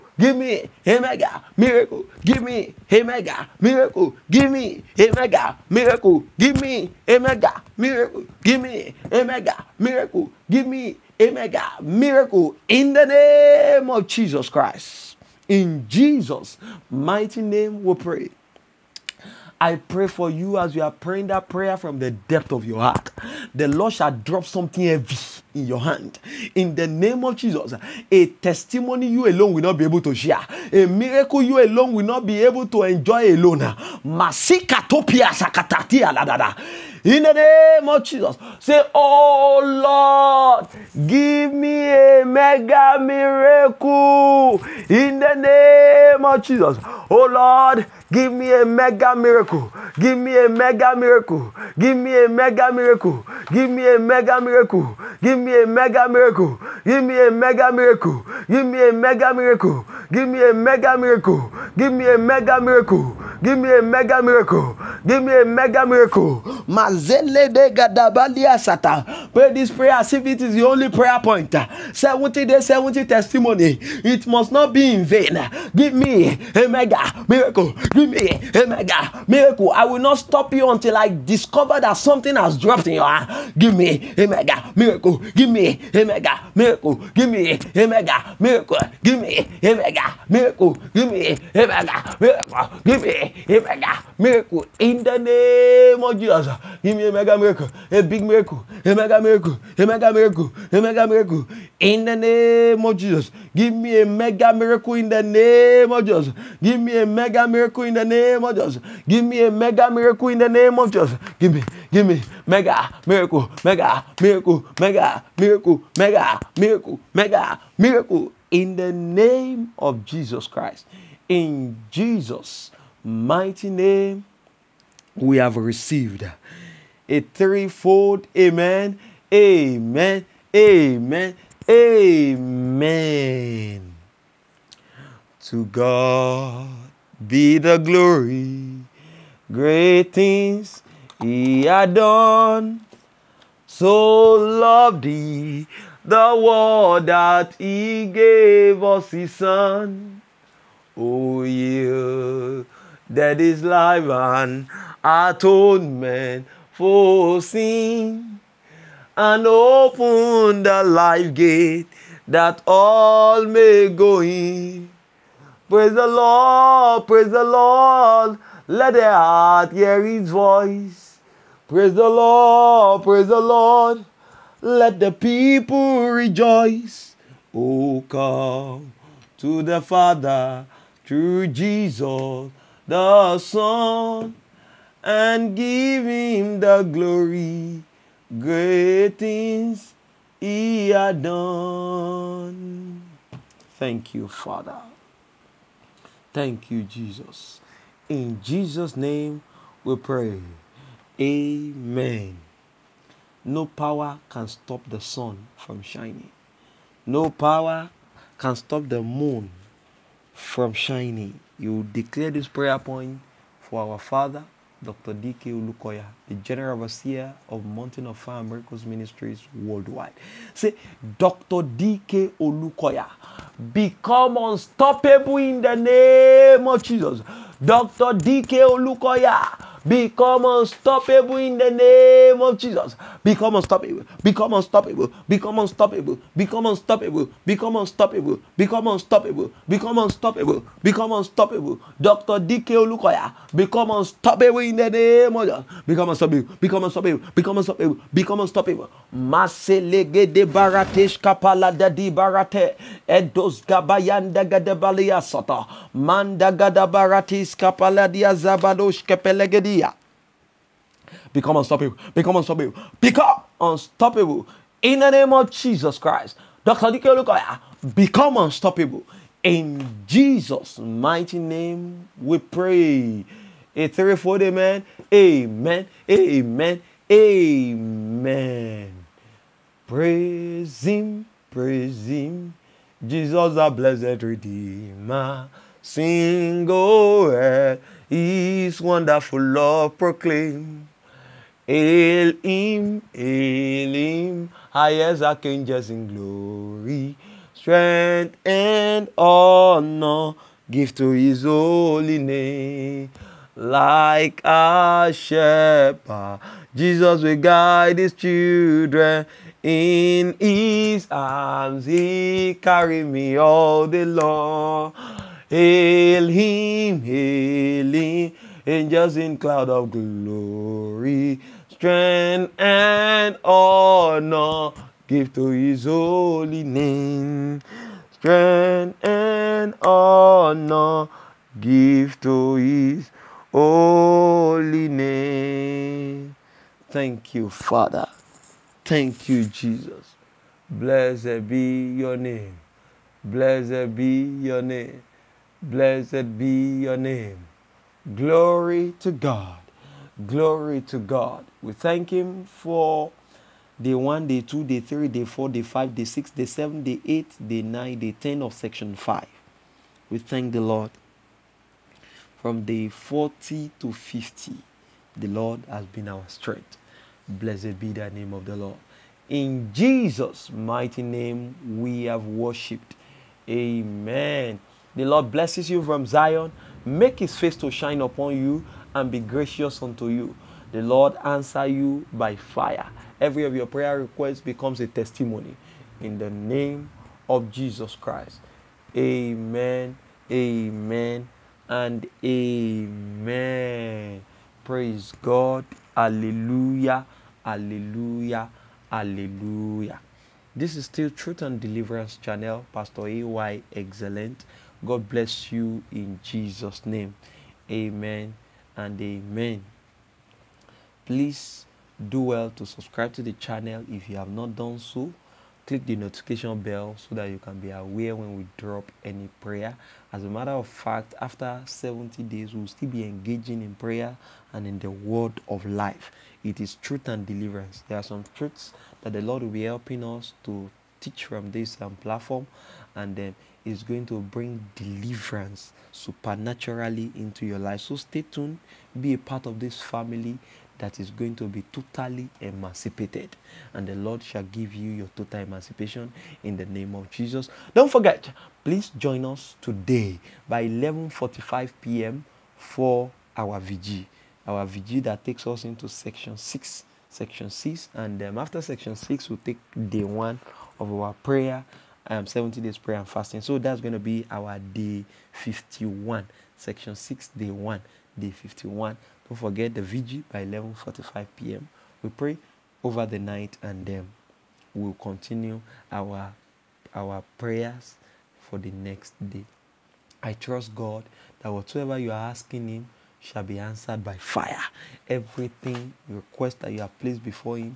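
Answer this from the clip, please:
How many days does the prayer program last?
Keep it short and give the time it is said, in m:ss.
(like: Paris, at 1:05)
70, at 1:11.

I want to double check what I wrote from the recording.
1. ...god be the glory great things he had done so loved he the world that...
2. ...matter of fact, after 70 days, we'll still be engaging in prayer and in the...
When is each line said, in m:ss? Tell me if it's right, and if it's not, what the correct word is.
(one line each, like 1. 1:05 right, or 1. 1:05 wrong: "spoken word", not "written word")
1. 2:15 right
2. 7:00 right.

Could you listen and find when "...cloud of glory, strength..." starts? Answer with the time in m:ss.
5:19.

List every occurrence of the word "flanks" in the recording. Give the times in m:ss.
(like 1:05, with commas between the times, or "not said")
not said.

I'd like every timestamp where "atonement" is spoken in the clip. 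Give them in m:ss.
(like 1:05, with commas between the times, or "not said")
2:35.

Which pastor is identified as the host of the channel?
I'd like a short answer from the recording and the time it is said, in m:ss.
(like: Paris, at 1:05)
Pastor AY Excellent, at 6:42.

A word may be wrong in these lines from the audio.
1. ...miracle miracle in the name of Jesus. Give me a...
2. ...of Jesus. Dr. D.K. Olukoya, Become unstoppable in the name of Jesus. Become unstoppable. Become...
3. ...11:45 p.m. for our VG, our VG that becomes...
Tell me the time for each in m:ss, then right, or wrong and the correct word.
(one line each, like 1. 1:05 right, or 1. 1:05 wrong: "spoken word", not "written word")
1. 1:33 right
2. 3:46 right
3. 7:30 wrong: "takes", not "becomes".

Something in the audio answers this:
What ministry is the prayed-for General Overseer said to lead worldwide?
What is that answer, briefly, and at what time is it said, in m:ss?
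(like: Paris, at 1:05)
Mountain of Fire Miracles Ministries, at 3:37.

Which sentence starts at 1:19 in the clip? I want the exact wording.
I will not stop you until I discover that something has dropped in your hand.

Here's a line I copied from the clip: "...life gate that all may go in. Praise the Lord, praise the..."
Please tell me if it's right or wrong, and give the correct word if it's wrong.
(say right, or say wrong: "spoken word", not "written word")
right.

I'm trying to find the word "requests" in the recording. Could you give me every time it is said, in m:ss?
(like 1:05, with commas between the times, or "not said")
6:23, 8:06.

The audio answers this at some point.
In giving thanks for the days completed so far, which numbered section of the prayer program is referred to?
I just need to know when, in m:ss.
5:58.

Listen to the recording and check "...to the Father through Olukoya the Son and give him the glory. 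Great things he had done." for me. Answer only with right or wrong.
wrong.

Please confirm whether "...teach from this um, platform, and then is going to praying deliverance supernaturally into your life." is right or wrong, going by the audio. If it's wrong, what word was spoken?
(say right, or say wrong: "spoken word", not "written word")
wrong: "bring", not "praying".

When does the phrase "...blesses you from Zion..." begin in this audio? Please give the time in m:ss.
6:15.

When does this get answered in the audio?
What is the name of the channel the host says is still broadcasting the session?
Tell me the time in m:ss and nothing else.
6:41.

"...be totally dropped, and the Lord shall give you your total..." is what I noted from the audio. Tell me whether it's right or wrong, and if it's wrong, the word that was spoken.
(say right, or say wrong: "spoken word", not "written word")
wrong: "emancipated", not "dropped".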